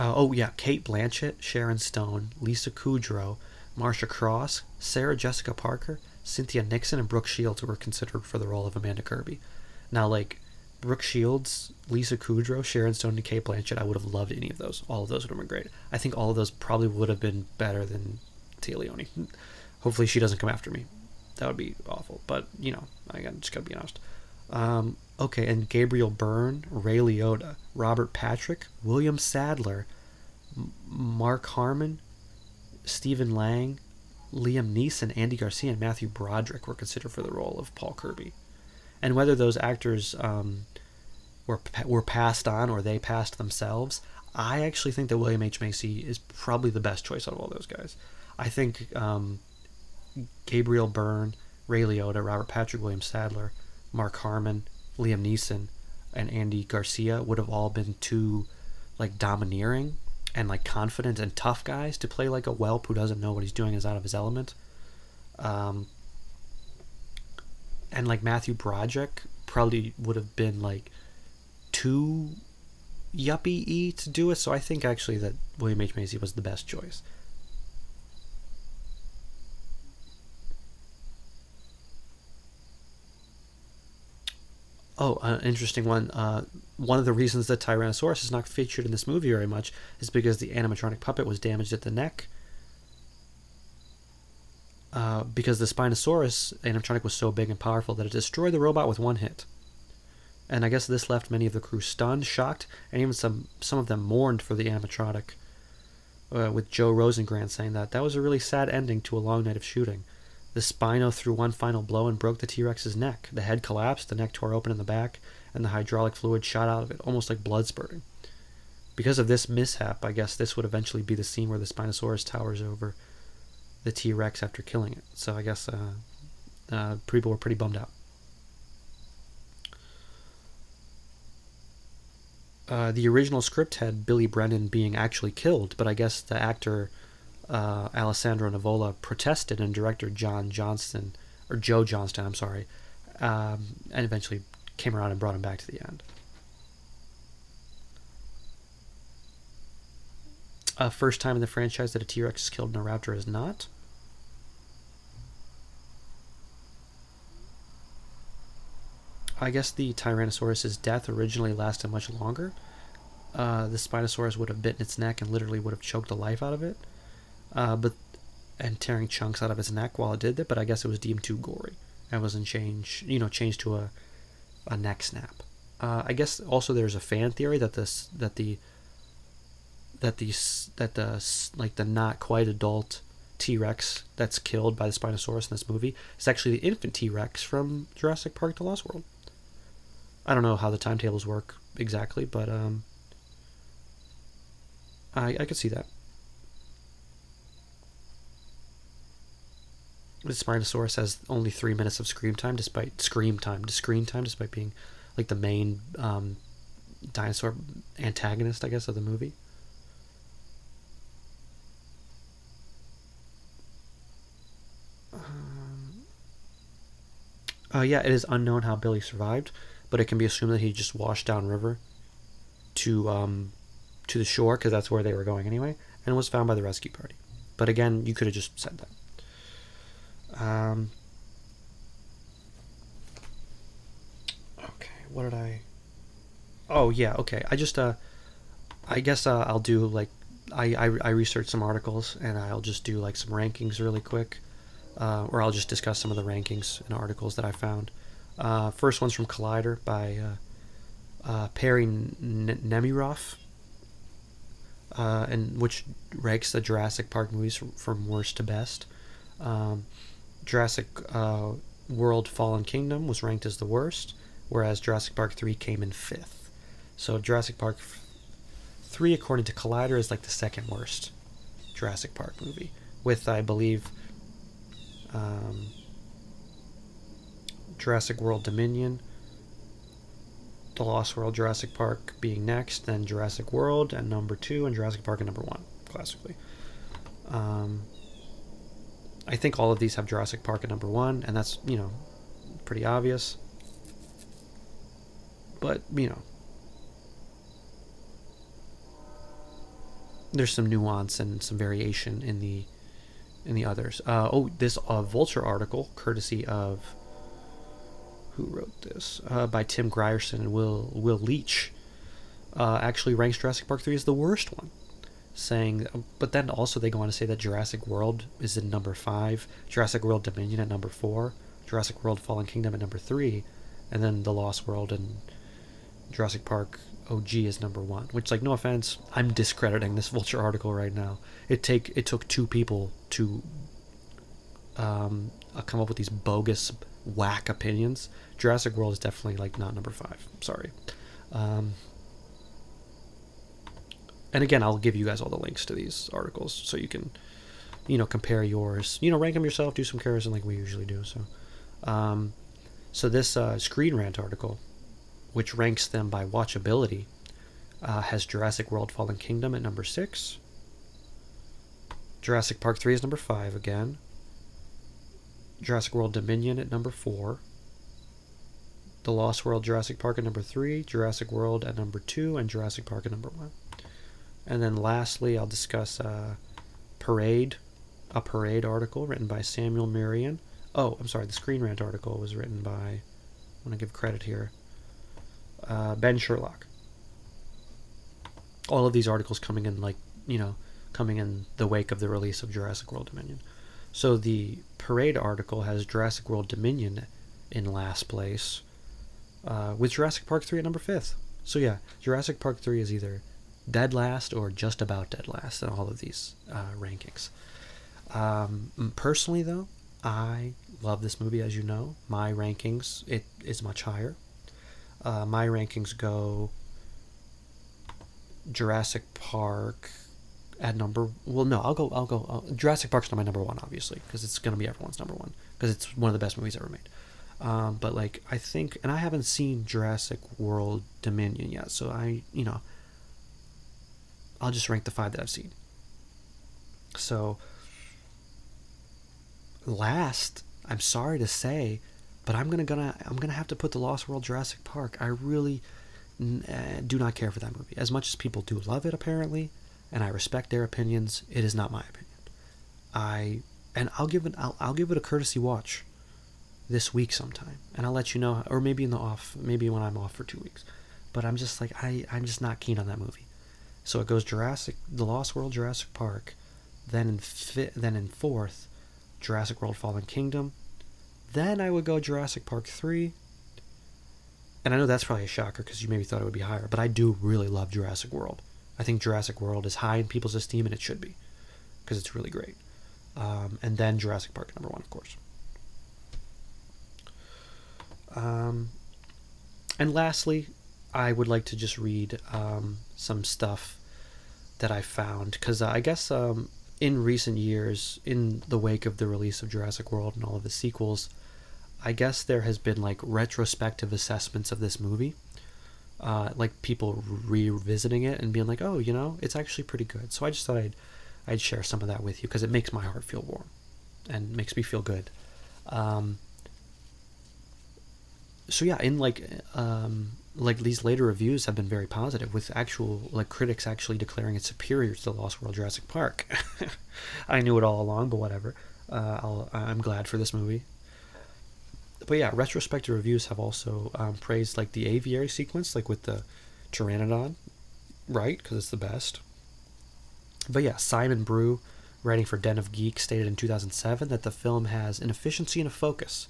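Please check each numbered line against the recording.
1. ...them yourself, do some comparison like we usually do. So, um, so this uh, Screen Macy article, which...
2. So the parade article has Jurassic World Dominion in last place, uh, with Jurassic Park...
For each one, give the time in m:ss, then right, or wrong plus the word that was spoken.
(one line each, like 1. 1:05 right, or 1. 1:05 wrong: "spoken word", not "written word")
1. 5:49 wrong: "Rant", not "Macy"
2. 6:33 right.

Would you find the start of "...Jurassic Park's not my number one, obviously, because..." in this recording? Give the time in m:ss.
7:02.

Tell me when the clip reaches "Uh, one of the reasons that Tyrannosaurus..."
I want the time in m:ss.
1:26.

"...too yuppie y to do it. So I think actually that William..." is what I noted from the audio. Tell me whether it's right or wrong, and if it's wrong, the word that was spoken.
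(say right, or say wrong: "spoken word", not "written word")
right.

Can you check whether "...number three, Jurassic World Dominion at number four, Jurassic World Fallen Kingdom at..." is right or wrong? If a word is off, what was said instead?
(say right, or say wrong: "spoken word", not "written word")
wrong: "five", not "three".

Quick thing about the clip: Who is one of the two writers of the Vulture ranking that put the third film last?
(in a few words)
Tim Grierson.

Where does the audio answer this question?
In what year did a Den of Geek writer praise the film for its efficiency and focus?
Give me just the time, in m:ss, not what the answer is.
9:03.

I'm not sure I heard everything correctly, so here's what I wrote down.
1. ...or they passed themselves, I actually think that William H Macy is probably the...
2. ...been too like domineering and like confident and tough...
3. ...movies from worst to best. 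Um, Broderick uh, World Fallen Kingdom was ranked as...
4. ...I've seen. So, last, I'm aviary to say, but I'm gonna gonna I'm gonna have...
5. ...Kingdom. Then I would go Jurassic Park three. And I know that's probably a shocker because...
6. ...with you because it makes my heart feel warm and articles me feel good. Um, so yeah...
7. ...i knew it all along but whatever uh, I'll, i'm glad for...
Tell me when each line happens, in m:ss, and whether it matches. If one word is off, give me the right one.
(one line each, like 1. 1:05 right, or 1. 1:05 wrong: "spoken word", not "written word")
1. 0:42 right
2. 0:57 right
3. 4:17 wrong: "Jurassic", not "Broderick"
4. 7:15 wrong: "sorry", not "aviary"
5. 7:50 right
6. 8:32 wrong: "makes", not "articles"
7. 8:47 right.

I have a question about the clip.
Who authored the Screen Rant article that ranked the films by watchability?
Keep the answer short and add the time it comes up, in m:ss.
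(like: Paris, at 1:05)
Ben Sherlock, at 6:25.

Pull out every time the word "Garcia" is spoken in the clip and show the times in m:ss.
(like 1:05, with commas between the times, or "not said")
0:35, 0:56.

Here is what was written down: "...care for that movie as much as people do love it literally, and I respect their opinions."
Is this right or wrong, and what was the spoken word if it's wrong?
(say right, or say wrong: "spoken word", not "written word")
wrong: "apparently", not "literally".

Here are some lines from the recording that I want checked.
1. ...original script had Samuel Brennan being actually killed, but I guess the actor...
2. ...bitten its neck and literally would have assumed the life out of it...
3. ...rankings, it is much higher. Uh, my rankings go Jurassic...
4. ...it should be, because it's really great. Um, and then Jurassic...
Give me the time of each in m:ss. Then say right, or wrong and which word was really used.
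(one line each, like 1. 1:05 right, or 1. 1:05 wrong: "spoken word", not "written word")
1. 2:13 wrong: "Billy", not "Samuel"
2. 2:44 wrong: "choked", not "assumed"
3. 6:52 right
4. 8:00 right.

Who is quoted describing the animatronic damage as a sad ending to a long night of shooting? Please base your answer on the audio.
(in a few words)
Joe Rosengrant.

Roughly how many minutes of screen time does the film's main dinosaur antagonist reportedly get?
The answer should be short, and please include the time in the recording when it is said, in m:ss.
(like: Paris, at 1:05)
3, at 3:21.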